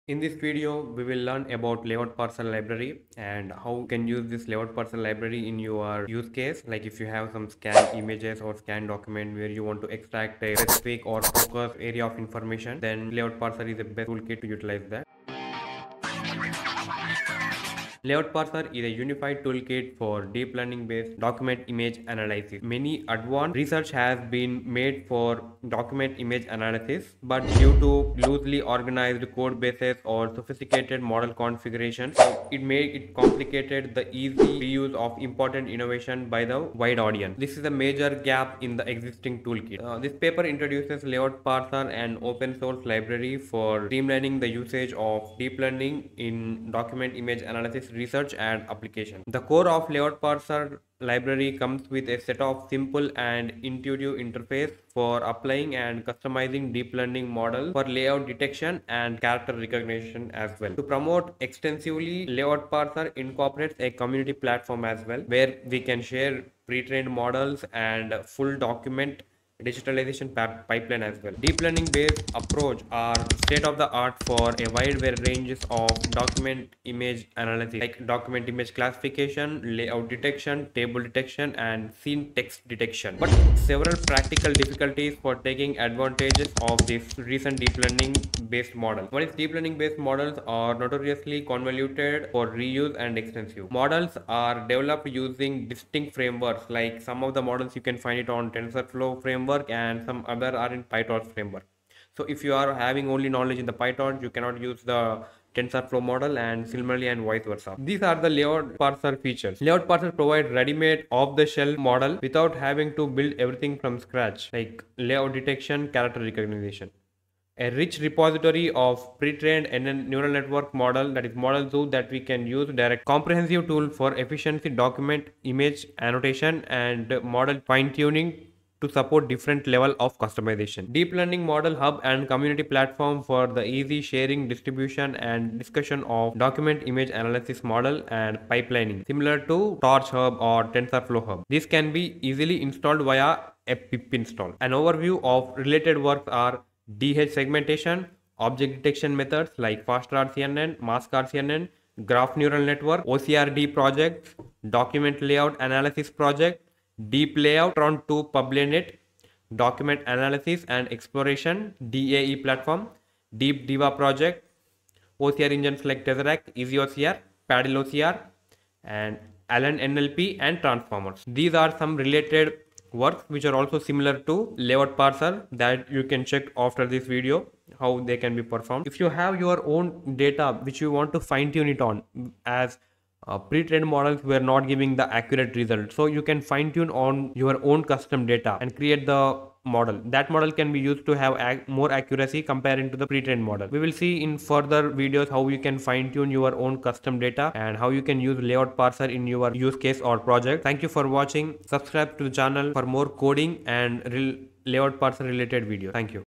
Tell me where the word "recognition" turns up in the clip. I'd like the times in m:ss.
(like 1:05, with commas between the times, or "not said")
0:59, 1:56.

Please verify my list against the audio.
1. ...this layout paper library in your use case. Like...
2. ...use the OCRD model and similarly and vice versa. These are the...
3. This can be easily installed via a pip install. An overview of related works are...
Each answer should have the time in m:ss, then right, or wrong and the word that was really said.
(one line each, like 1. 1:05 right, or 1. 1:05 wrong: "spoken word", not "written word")
1. 0:04 wrong: "parser", not "paper"
2. 1:44 wrong: "TensorFlow", not "OCRD"
3. 2:21 right.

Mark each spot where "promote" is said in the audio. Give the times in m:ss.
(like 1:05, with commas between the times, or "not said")
1:00.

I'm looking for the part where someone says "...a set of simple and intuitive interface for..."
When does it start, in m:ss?
0:52.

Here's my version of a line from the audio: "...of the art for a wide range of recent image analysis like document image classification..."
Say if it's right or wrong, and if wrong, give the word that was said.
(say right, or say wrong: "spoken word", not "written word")
wrong: "document", not "recent".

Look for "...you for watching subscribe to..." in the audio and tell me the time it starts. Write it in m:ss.
3:20.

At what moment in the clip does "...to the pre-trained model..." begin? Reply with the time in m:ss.
3:12.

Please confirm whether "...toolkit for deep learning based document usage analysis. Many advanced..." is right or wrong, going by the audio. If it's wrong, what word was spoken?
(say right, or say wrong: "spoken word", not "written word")
wrong: "image", not "usage".